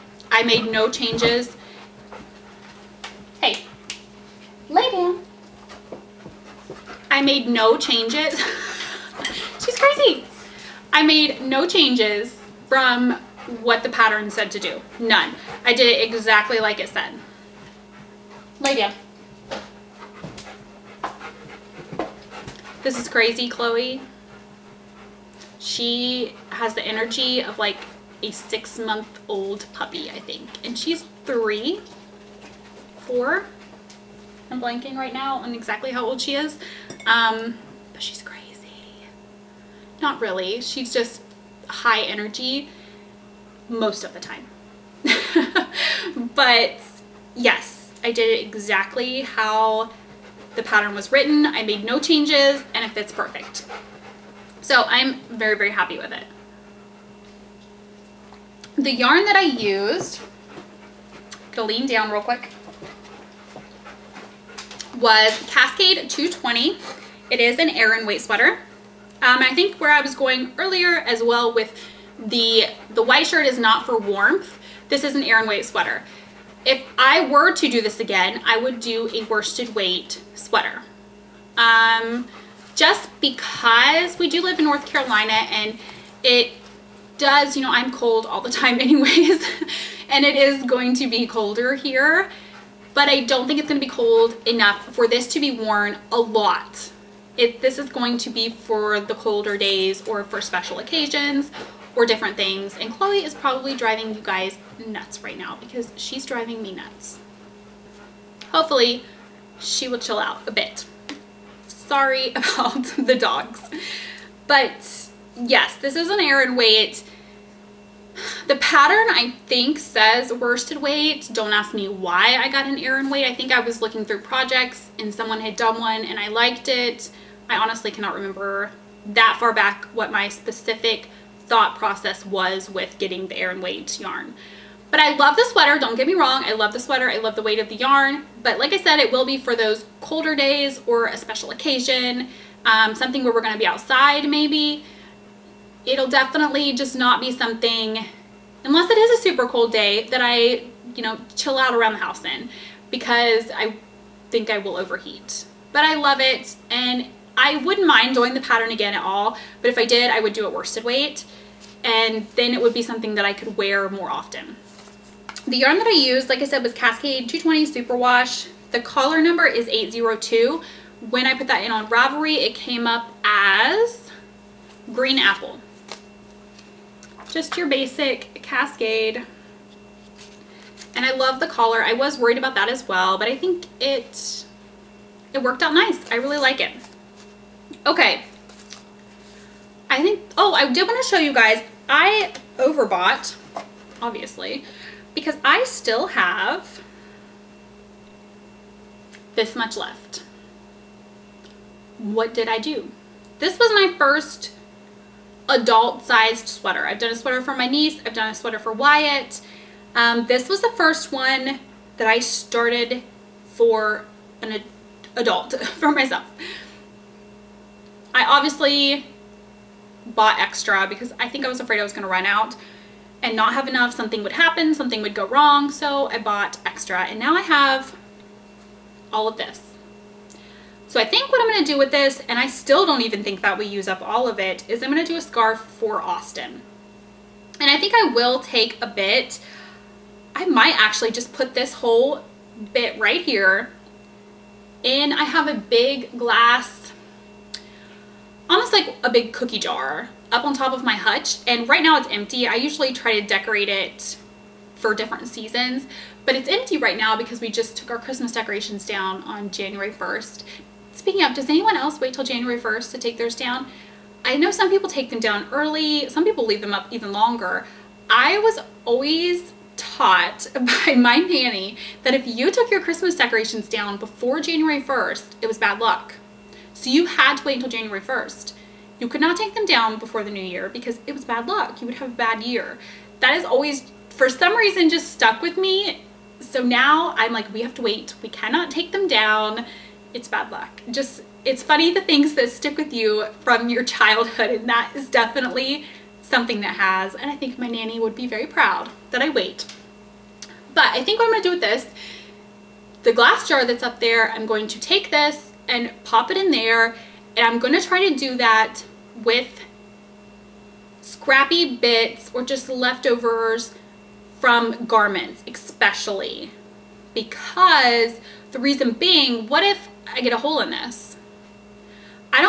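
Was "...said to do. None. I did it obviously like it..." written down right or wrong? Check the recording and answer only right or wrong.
wrong.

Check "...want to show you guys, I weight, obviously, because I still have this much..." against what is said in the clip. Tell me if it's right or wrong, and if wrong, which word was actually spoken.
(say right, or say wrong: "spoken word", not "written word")
wrong: "overbought", not "weight".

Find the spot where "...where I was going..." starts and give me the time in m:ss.
1:09.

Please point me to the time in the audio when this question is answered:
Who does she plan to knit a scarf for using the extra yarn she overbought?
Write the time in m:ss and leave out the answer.
3:56.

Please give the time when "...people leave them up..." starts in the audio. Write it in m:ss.
4:26.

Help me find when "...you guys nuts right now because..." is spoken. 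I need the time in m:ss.
1:44.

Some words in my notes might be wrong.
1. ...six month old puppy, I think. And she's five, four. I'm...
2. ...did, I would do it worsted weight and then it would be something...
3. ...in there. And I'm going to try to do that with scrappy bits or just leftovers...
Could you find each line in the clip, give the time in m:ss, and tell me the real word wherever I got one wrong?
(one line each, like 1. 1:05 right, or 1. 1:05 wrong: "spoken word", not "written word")
1. 0:28 wrong: "three", not "five"
2. 2:39 right
3. 5:06 right.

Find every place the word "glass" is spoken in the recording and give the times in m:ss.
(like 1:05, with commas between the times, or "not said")
4:06, 5:03.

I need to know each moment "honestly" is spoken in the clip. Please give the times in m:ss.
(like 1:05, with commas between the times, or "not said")
2:07.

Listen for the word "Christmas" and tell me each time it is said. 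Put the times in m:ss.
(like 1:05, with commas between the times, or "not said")
4:17, 4:32.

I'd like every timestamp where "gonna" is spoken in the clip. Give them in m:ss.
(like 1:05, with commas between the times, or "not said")
2:23, 5:01.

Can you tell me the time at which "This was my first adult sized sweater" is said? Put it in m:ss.
3:23.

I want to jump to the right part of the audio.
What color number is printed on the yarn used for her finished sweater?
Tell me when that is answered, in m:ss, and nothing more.
2:49.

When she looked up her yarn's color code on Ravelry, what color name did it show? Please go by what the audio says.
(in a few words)
Green Apple.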